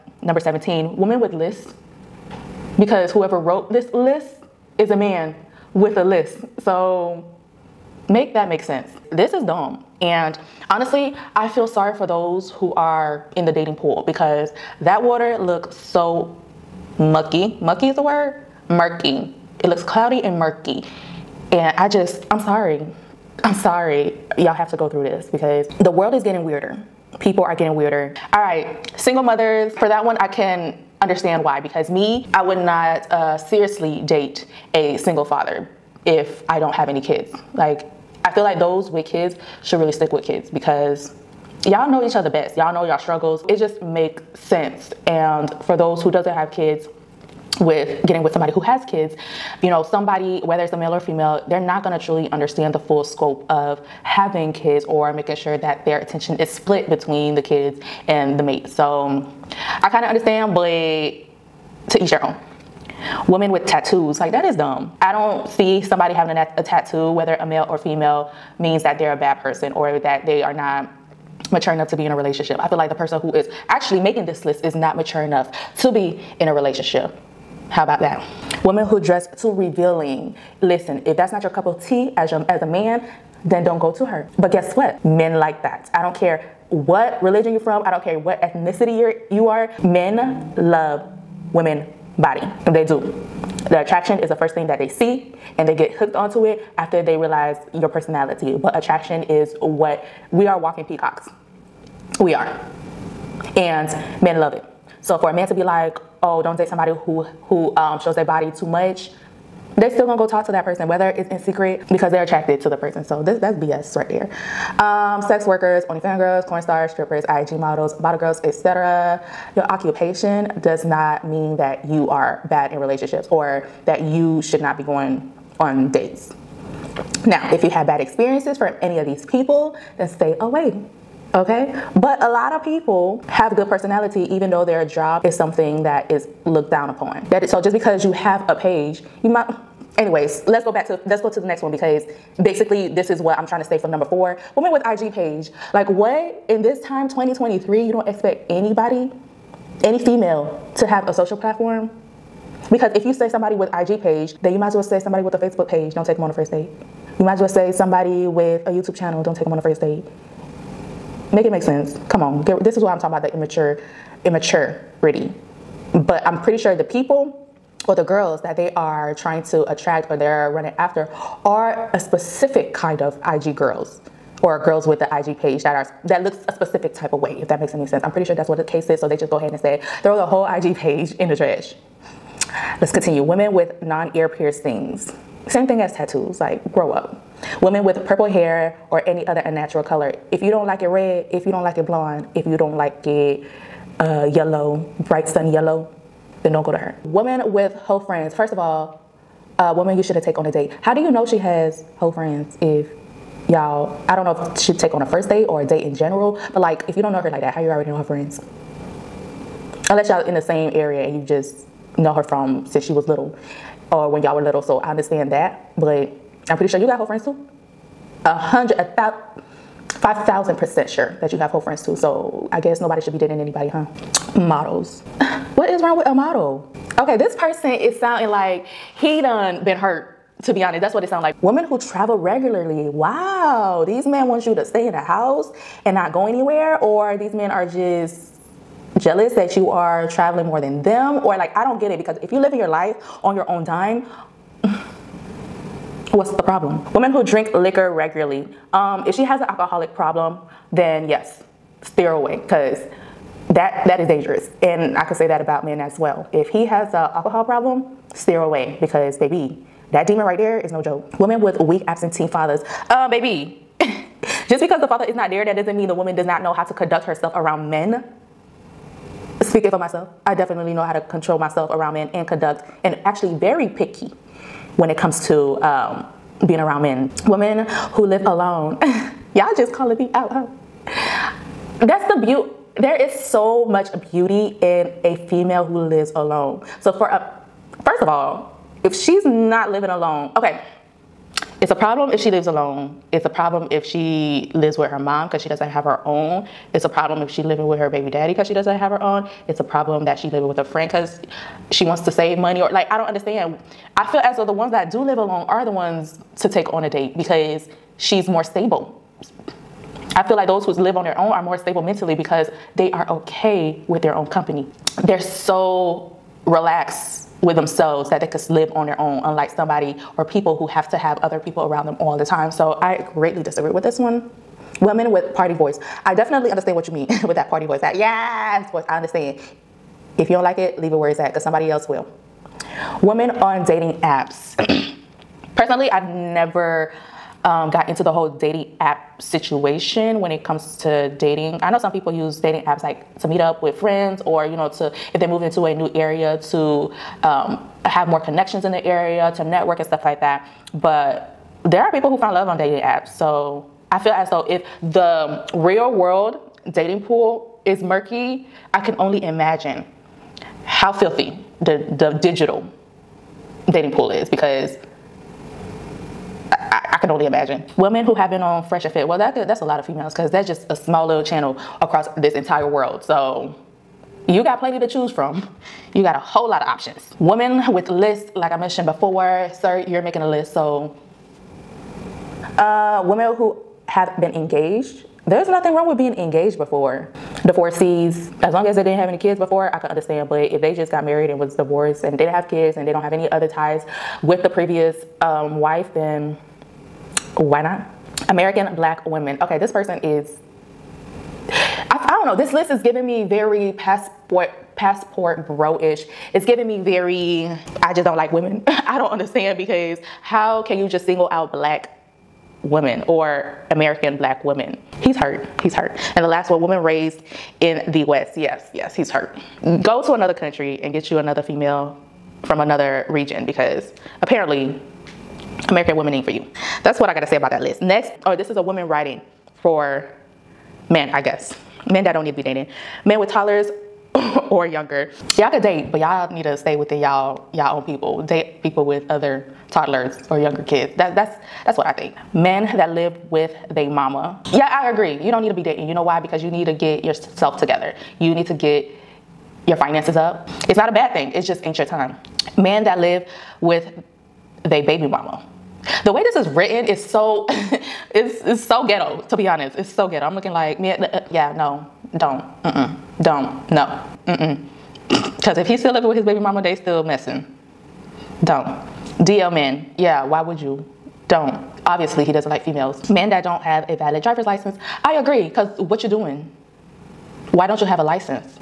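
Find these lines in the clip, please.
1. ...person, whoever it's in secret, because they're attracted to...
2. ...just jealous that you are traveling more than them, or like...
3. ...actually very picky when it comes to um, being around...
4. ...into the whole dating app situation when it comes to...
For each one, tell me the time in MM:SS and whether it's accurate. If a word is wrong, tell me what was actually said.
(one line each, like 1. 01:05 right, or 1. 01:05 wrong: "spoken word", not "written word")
1. 01:50 wrong: "whether", not "whoever"
2. 03:57 right
3. 04:33 right
4. 05:37 right.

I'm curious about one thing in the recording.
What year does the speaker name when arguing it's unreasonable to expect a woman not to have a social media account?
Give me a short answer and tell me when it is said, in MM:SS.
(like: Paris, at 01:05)
2023, at 02:27.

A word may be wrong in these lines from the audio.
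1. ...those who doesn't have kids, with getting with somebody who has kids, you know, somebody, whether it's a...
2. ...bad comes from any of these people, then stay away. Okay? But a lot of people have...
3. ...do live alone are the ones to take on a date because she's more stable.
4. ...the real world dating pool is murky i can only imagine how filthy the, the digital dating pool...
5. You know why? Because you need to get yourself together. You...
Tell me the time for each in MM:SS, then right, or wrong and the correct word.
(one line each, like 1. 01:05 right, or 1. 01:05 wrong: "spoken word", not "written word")
1. 00:45 right
2. 02:07 wrong: "experiences", not "comes"
3. 05:04 right
4. 05:54 right
5. 07:25 right.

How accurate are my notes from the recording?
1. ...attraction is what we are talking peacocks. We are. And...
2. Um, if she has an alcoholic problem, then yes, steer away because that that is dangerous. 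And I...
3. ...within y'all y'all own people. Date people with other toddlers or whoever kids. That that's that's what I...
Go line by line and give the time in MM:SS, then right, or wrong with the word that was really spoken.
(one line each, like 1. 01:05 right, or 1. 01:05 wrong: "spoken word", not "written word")
1. 01:38 wrong: "walking", not "talking"
2. 04:08 right
3. 07:16 wrong: "younger", not "whoever".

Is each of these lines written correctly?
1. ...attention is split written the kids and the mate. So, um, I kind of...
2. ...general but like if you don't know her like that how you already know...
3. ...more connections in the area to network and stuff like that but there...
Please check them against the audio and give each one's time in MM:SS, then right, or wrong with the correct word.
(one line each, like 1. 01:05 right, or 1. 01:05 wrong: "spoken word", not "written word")
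1. 00:55 wrong: "between", not "written"
2. 03:25 right
3. 05:48 right.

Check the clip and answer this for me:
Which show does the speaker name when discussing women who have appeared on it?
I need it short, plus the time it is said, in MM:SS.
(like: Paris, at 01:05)
Fresh and Fit, at 06:08.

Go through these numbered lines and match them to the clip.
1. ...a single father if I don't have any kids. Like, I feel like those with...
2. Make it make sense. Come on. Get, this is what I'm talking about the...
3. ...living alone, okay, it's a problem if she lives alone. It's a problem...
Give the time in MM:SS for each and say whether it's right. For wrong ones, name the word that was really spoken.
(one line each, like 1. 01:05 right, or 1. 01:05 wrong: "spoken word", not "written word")
1. 00:34 right
2. 02:41 right
3. 04:49 right.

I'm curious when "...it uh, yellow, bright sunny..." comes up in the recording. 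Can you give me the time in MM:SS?
03:13.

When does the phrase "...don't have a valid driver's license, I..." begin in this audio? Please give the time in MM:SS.
07:53.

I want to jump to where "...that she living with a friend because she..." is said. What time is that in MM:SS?
05:00.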